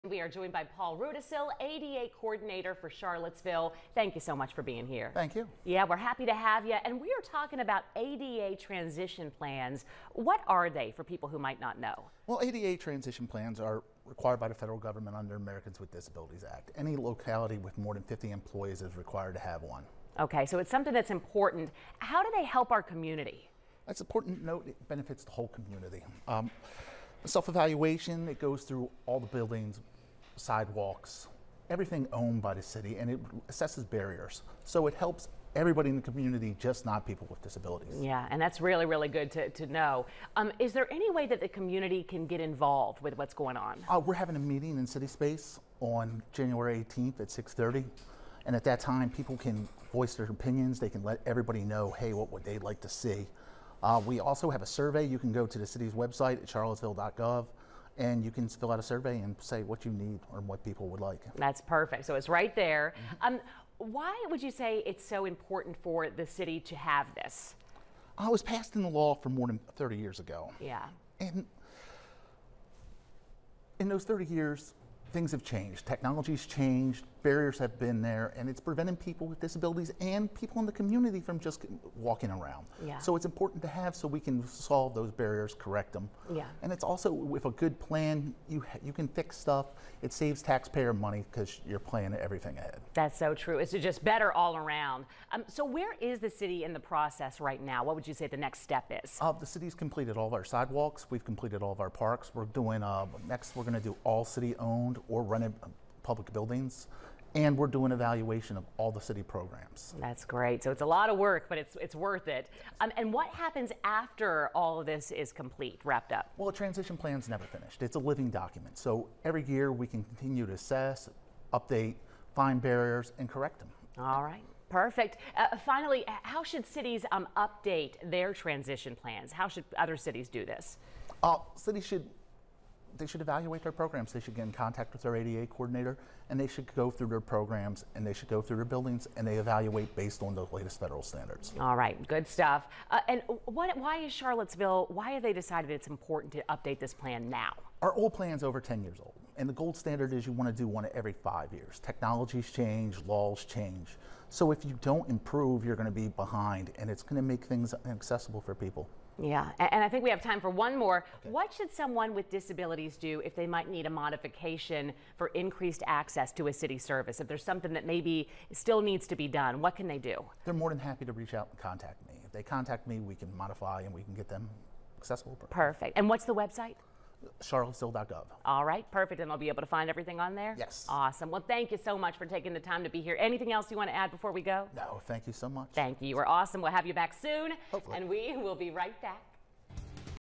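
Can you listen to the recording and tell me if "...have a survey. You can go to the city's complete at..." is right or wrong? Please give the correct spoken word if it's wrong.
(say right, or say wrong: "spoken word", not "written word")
wrong: "website", not "complete".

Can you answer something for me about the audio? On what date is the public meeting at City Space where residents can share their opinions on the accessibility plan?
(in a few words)
January 18th.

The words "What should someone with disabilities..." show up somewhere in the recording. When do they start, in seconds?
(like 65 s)
161 s.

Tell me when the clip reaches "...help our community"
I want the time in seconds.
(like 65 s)
22 s.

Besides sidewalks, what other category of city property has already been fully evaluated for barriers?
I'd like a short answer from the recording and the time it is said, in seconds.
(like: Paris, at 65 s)
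parks, at 101 s.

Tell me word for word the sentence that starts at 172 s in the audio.
If they contact me, we can modify and we can get them accessible.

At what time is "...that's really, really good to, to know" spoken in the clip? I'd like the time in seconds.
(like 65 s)
38 s.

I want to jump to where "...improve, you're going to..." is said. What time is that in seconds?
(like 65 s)
155 s.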